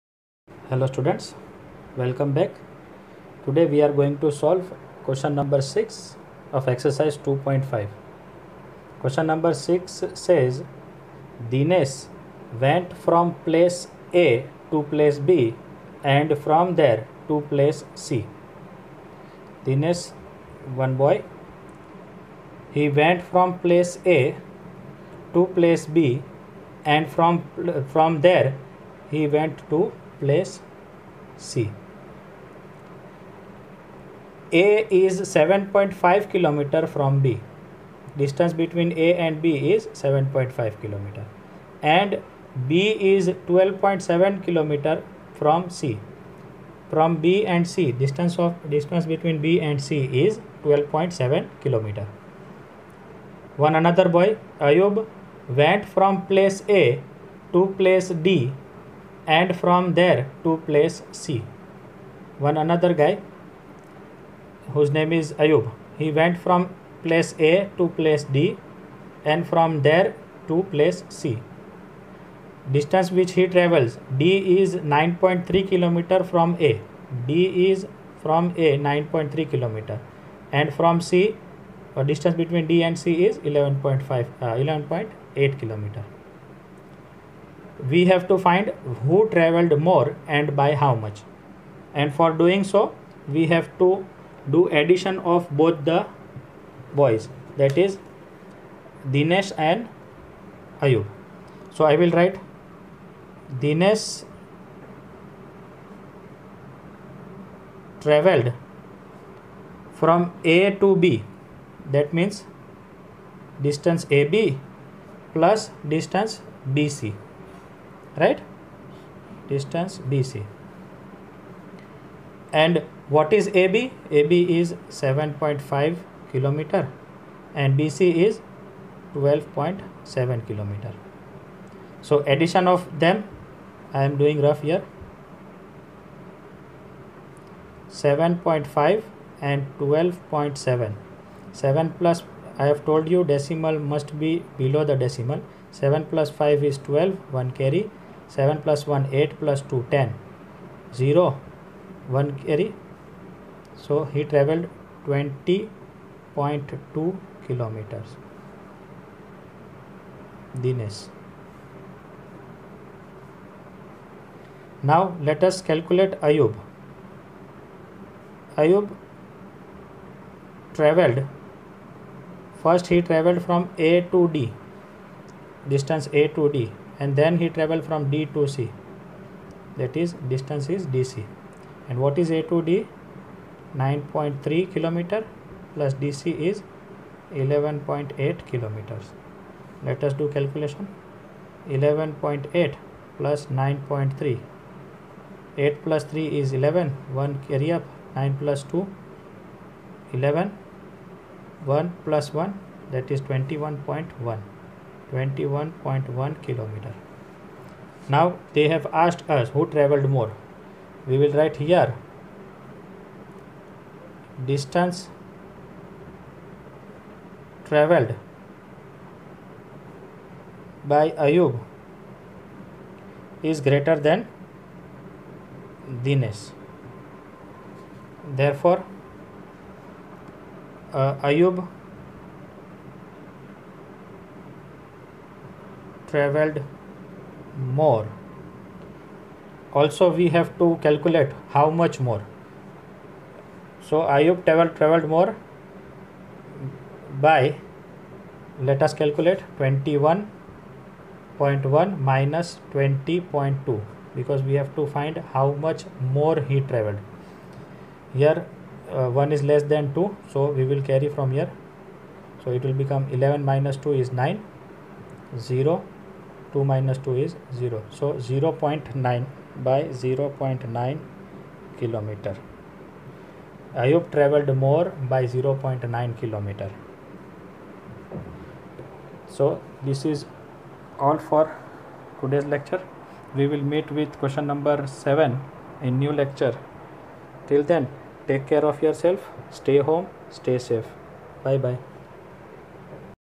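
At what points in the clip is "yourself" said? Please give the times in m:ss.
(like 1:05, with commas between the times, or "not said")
4:48.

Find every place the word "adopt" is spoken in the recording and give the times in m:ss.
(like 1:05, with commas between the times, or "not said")
not said.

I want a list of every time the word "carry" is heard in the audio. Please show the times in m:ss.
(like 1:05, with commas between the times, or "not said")
2:27, 2:32, 3:17, 4:20.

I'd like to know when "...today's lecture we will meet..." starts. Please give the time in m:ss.
4:42.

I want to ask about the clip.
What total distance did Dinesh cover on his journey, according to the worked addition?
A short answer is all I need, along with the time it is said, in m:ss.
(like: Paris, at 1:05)
20.2 km, at 2:35.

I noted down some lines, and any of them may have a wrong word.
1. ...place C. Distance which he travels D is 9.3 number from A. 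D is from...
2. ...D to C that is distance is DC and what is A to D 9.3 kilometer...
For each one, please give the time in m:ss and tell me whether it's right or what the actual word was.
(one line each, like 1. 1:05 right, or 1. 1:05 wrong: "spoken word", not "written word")
1. 1:10 wrong: "kilometer", not "number"
2. 2:58 right.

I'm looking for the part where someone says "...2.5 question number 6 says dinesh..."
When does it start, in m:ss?
0:07.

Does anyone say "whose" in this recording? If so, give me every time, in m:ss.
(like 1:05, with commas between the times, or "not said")
1:04.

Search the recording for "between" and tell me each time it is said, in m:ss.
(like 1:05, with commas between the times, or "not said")
0:38, 0:49, 1:22.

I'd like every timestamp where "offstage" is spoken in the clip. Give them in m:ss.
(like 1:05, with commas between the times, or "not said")
not said.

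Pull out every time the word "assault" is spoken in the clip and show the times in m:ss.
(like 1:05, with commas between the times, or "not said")
not said.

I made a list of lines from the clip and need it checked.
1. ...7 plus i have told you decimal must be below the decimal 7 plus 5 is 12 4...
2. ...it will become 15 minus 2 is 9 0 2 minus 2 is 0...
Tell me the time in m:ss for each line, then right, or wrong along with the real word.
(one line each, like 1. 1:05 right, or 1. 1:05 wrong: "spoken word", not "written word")
1. 2:21 wrong: "1", not "4"
2. 4:22 wrong: "11", not "15".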